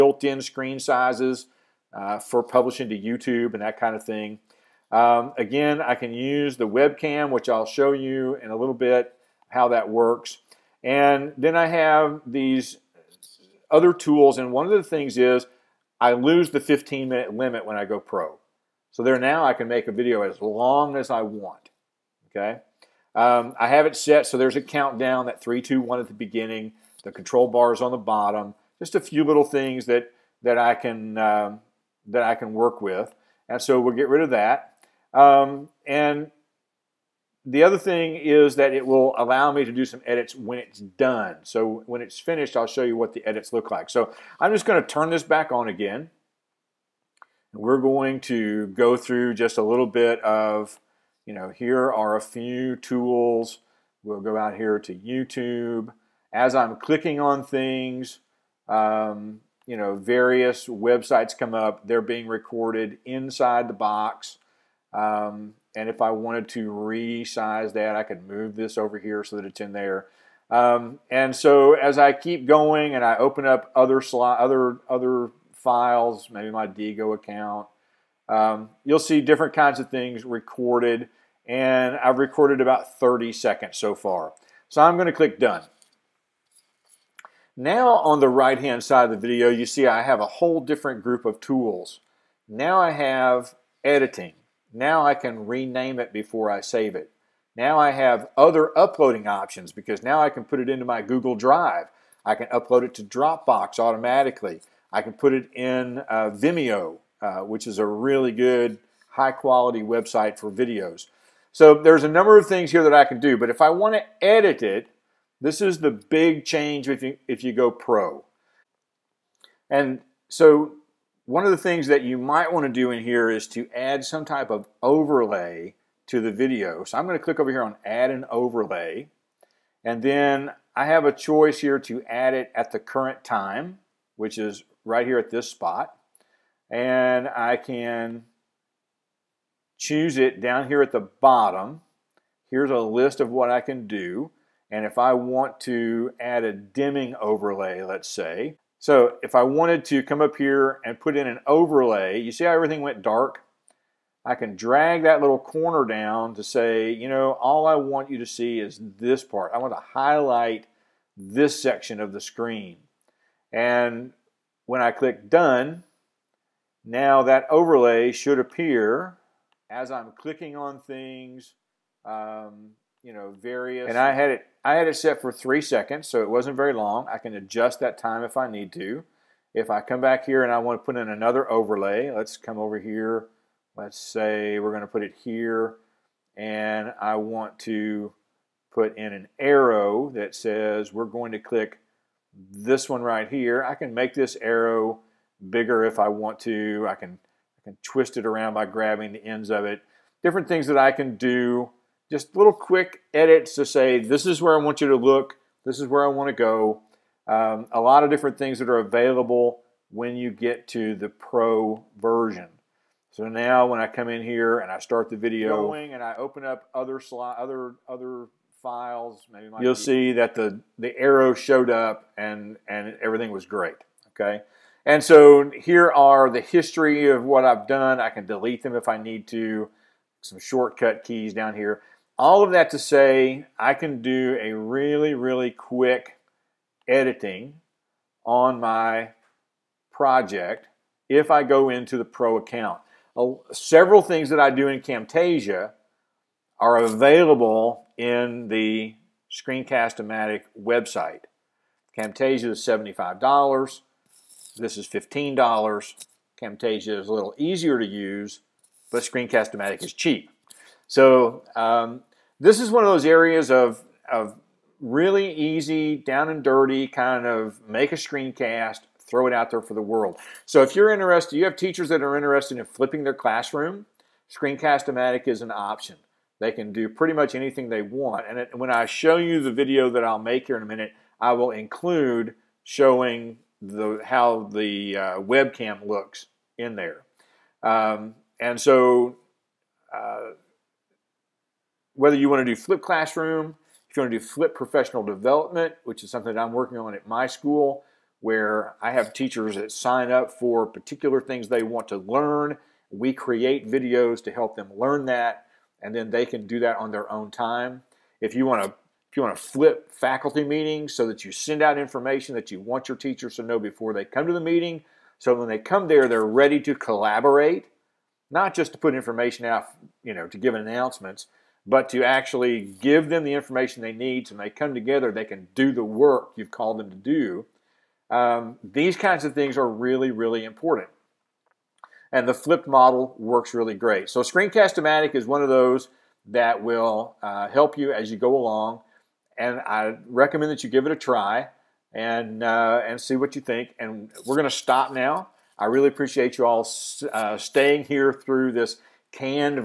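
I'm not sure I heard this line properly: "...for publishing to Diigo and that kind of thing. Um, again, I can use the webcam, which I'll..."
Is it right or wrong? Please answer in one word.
wrong.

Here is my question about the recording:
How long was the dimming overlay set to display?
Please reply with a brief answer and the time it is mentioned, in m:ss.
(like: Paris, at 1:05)
3 seconds, at 2:55.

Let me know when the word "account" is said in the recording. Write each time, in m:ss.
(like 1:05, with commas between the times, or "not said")
1:17, 4:02.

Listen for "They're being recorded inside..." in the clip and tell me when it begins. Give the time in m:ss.
1:01.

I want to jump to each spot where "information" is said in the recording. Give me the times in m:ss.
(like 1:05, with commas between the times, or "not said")
5:11, 5:18, 5:23.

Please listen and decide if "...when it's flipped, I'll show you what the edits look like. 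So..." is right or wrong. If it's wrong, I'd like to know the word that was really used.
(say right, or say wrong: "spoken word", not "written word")
wrong: "finished", not "flipped".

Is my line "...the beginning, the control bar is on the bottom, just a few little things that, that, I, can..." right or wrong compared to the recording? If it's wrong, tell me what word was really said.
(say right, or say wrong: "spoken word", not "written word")
right.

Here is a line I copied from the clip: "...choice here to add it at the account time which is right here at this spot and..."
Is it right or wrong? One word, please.
wrong.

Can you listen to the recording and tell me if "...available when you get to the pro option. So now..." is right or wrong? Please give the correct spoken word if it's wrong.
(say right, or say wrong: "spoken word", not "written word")
wrong: "version", not "option".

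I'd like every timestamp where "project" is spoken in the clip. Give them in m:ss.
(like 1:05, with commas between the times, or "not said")
3:59.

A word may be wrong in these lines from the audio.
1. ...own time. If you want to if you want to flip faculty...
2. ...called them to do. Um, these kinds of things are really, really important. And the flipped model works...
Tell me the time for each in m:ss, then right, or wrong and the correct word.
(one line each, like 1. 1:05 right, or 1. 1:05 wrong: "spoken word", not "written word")
1. 5:07 right
2. 5:26 right.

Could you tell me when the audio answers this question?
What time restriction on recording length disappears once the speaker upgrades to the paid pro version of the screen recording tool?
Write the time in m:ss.
0:16.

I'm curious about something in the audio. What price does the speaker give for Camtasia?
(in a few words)
$75.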